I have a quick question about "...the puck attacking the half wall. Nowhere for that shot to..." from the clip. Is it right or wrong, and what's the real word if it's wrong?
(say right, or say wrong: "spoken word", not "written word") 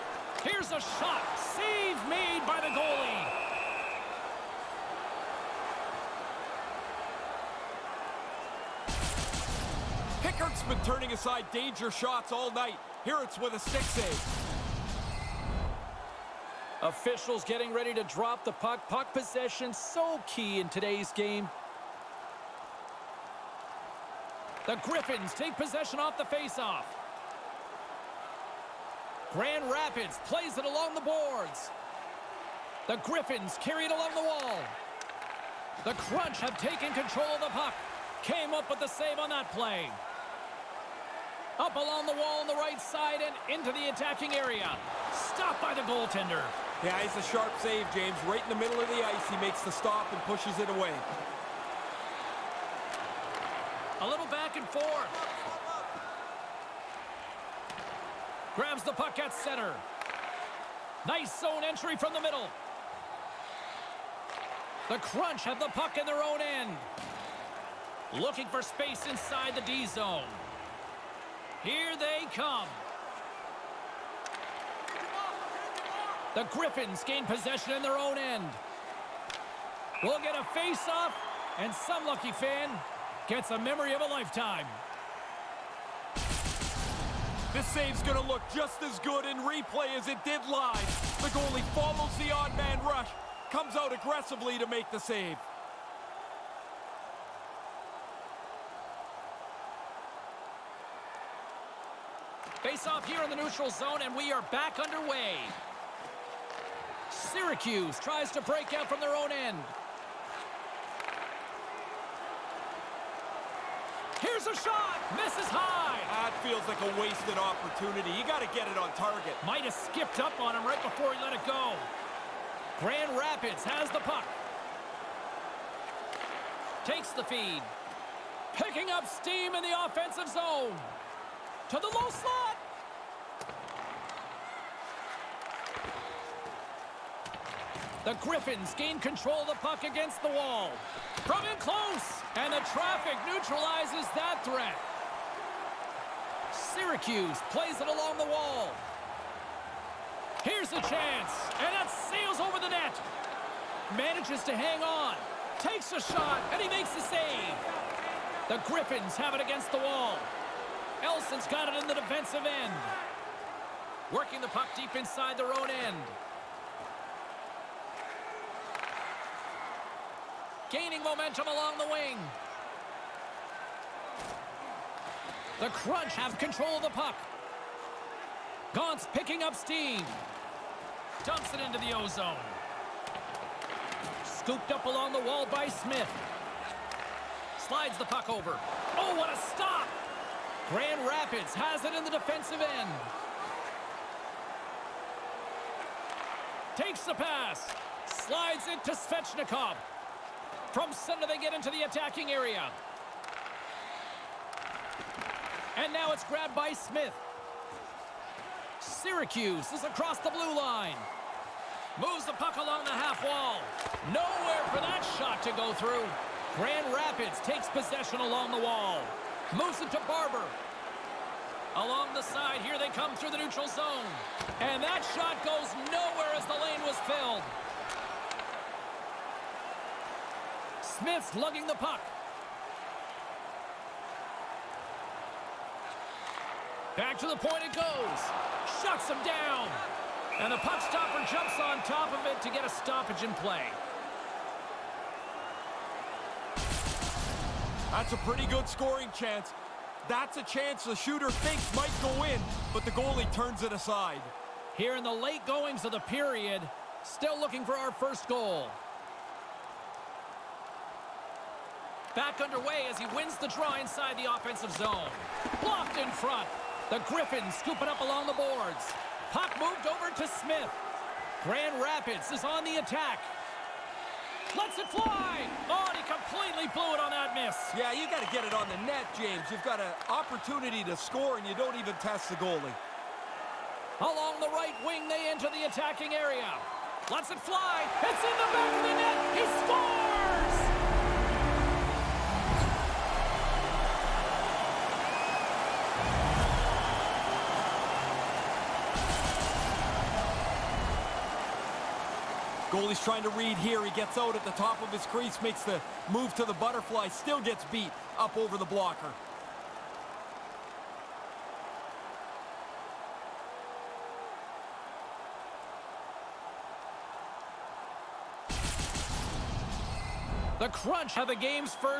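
wrong: "along", not "attacking".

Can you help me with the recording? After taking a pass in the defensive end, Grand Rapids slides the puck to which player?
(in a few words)
Svechnikov.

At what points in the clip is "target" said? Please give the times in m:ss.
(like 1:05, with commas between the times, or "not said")
1:58.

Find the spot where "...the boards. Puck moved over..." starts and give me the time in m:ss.
4:28.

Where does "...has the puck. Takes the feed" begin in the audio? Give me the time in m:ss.
2:03.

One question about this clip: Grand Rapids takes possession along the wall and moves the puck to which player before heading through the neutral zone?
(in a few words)
Barber.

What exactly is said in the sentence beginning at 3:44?
And that shot goes nowhere as the lane was filled.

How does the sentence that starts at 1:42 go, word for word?
Face off here in the neutral zone, and we are back underway.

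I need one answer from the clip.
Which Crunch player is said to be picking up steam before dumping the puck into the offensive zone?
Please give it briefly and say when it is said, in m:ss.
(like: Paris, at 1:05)
Gaunt, at 2:58.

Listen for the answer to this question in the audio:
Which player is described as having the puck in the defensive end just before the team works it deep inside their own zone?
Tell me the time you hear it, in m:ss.
2:41.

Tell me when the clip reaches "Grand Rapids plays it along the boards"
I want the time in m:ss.
0:29.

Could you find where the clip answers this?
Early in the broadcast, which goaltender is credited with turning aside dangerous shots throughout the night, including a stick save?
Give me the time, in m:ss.
0:10.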